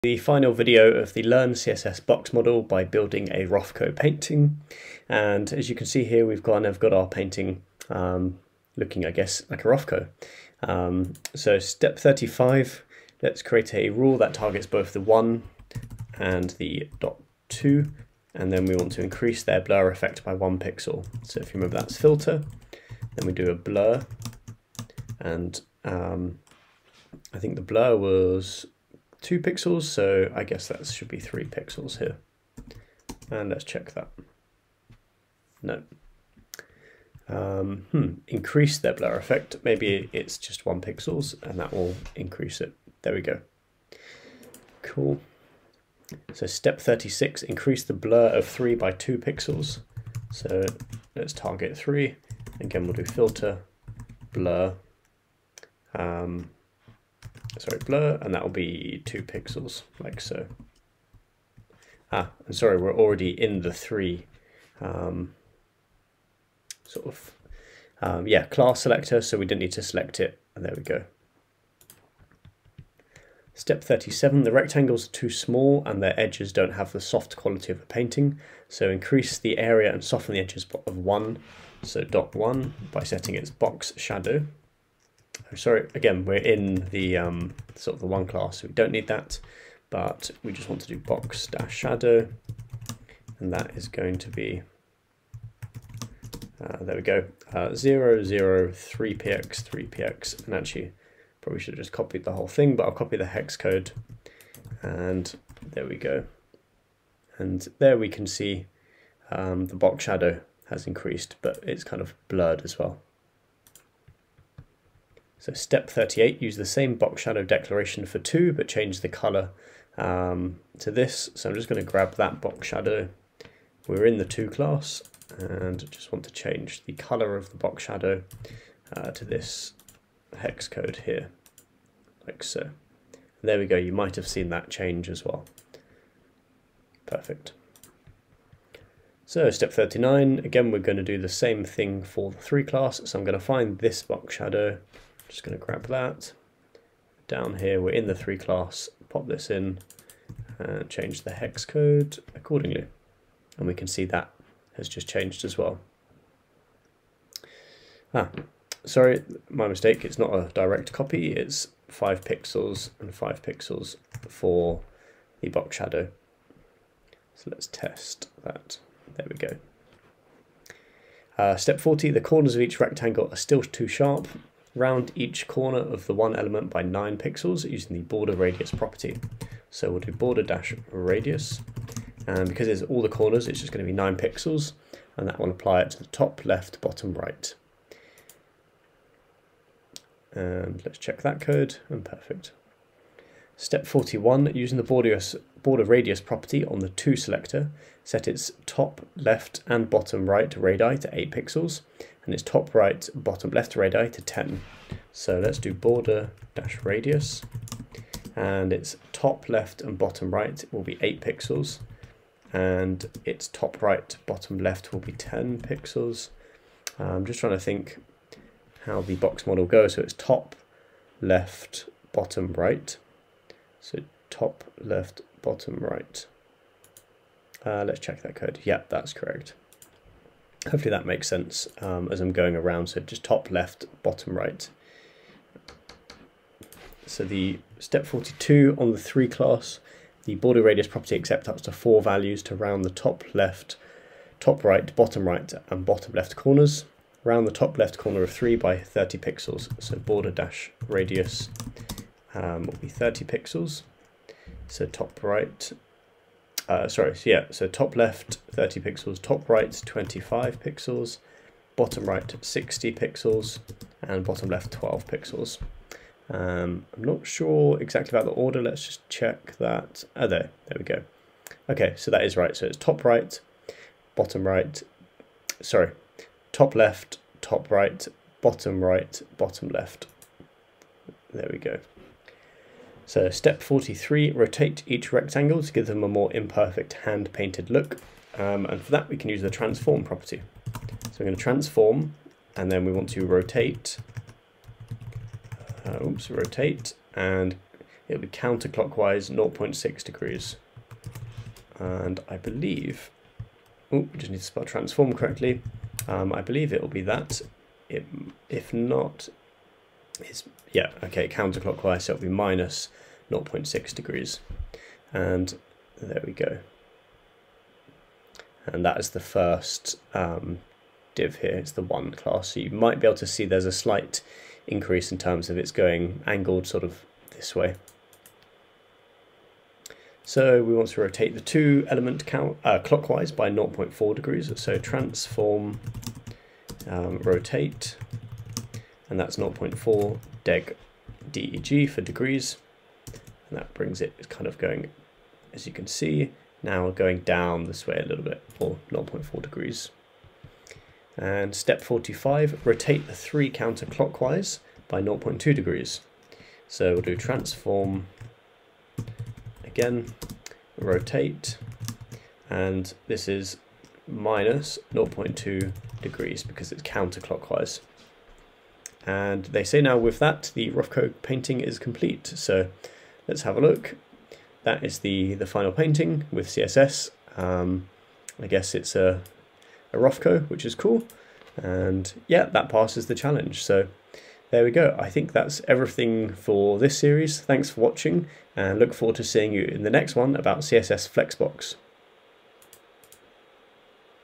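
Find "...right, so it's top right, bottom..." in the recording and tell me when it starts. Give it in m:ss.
4:32.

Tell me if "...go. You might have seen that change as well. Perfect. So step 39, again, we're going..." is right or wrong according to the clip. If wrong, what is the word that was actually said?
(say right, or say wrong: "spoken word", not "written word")
right.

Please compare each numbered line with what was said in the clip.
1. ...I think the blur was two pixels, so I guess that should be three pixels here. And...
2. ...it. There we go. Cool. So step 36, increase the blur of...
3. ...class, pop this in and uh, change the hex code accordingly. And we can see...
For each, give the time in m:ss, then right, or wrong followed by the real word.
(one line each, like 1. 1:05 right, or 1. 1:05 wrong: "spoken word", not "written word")
1. 0:27 right
2. 0:42 right
3. 2:28 right.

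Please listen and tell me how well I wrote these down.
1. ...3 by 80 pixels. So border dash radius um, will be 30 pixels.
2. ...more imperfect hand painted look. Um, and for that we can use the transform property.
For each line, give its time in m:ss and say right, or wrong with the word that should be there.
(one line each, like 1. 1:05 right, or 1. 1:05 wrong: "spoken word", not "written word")
1. 4:08 wrong: "30", not "80"
2. 4:46 right.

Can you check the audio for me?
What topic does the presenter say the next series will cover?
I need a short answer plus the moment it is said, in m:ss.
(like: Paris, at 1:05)
CSS Flexbox, at 6:30.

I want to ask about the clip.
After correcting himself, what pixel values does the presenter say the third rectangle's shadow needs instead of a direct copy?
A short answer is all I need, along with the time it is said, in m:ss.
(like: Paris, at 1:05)
5px and 5px, at 2:41.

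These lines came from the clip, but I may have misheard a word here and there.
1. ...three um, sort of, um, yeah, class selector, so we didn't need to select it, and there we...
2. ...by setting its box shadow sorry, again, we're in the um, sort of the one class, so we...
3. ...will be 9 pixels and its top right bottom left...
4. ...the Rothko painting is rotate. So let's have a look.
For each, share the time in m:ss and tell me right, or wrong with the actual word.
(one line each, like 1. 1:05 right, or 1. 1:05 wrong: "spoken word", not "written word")
1. 1:03 right
2. 1:22 right
3. 3:30 wrong: "8", not "9"
4. 6:10 wrong: "complete", not "rotate".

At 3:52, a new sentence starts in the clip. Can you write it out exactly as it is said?
So just top left, bottom right.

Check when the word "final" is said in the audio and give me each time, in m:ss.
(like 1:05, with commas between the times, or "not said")
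0:00, 6:15.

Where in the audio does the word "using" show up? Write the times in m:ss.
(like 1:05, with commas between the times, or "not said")
2:57, 3:14.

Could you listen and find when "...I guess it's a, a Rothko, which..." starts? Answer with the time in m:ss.
6:18.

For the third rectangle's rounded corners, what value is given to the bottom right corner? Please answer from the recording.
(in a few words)
60 pixels.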